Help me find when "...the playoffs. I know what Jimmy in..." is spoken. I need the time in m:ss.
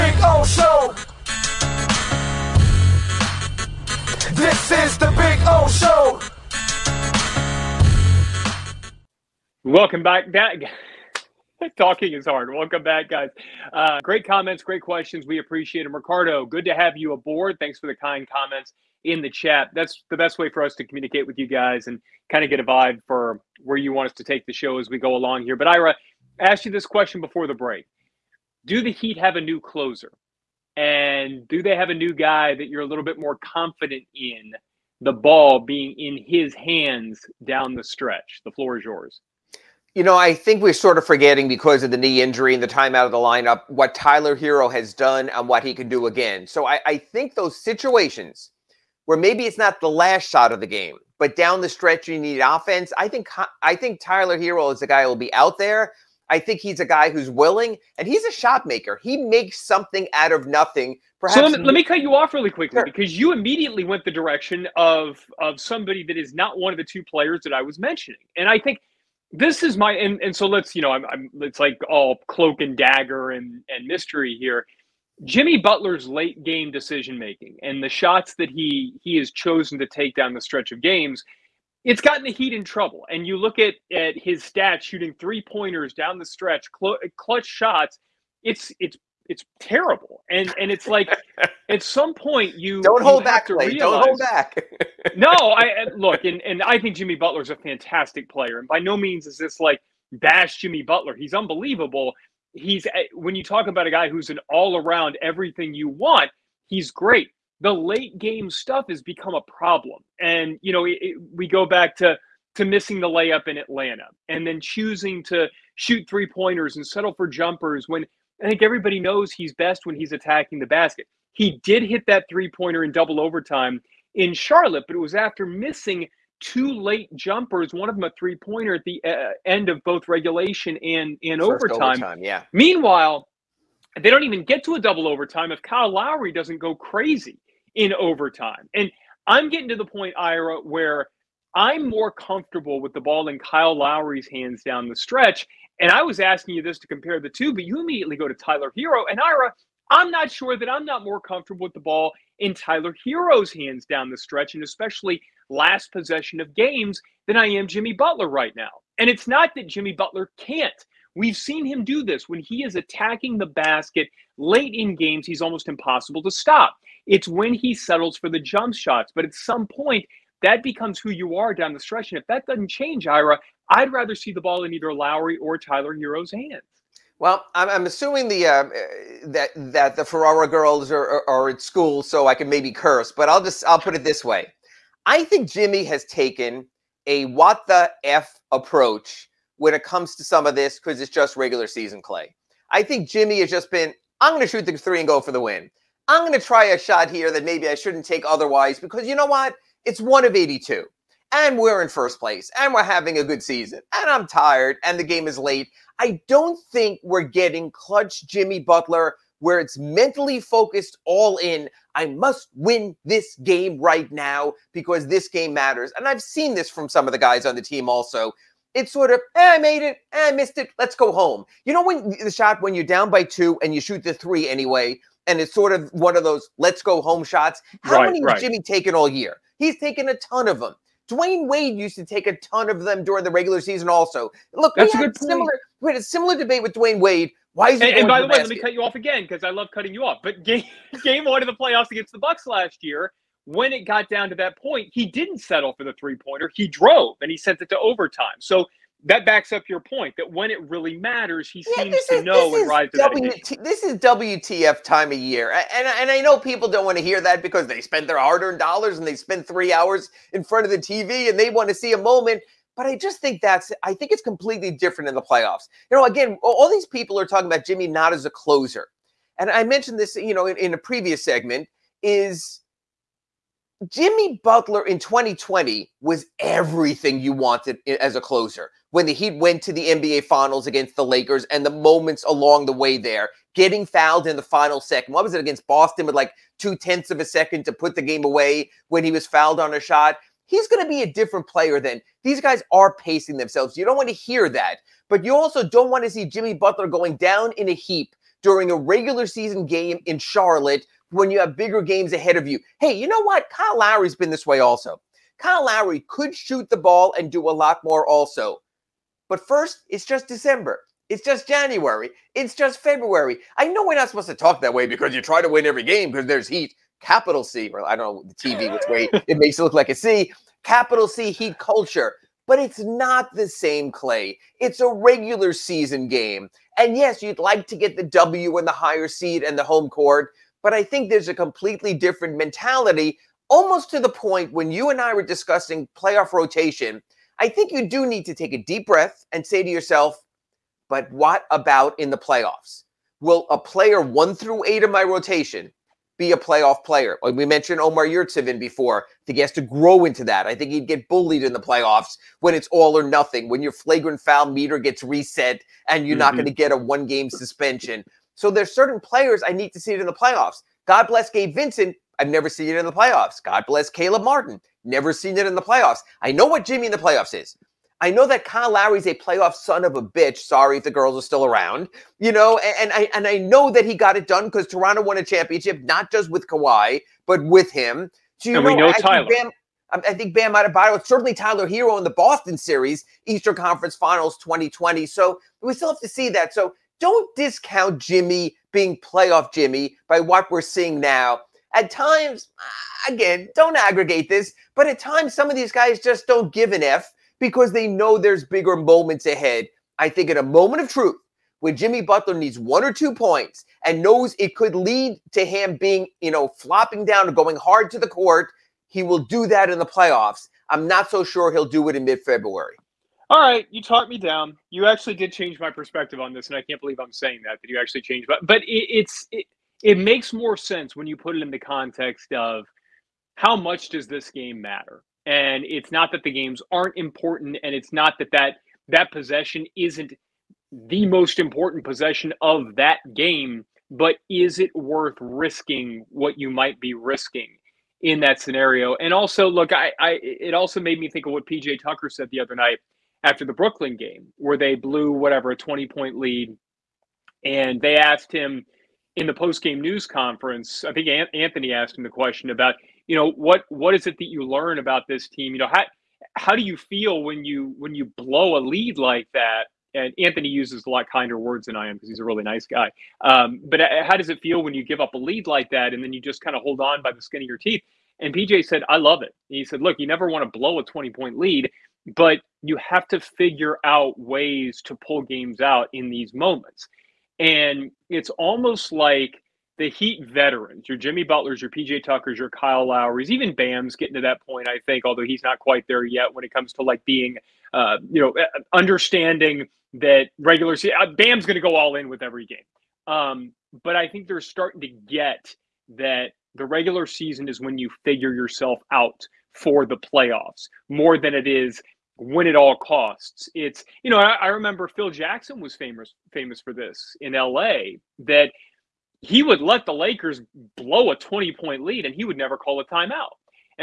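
6:05.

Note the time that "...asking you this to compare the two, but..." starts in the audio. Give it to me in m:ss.
2:26.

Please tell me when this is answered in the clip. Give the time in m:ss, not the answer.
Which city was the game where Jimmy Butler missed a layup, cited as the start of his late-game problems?
1:53.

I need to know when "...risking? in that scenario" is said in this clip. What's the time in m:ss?
7:16.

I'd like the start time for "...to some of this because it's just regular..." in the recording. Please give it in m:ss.
3:10.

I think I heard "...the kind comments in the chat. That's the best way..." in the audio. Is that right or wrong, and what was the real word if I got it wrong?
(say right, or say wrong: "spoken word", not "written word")
right.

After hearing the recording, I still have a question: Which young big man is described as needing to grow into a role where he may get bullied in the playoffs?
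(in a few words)
Omer Yurtseven.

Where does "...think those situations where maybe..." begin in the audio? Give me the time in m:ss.
0:46.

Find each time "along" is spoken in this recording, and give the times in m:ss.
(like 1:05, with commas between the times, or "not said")
0:25, 4:42.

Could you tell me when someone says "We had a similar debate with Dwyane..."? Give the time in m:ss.
3:55.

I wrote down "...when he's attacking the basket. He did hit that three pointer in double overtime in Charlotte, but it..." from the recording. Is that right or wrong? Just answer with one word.
right.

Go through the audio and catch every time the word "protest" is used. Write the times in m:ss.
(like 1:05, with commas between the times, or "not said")
not said.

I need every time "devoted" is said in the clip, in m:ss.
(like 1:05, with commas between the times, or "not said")
not said.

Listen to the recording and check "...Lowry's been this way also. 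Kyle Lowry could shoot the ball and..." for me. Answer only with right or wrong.
right.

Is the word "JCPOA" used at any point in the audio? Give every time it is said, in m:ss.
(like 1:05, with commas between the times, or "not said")
not said.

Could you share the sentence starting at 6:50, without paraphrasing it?
I'm not so sure he'll do it in mid February all right, you talked me down.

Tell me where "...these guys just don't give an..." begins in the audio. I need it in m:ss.
6:35.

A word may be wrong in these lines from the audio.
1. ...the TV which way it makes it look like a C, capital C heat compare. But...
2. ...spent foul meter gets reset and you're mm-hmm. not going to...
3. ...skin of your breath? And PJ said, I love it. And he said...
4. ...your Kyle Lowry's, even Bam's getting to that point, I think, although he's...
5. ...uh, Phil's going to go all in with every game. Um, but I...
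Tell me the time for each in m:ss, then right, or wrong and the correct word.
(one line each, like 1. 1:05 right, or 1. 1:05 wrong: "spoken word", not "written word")
1. 5:18 wrong: "culture", not "compare"
2. 5:53 wrong: "flagrant", not "spent"
3. 7:47 wrong: "teeth", not "breath"
4. 8:02 right
5. 8:11 wrong: "Bam", not "Phil".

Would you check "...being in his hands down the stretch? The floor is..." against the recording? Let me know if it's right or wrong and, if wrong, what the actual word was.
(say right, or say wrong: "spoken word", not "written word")
right.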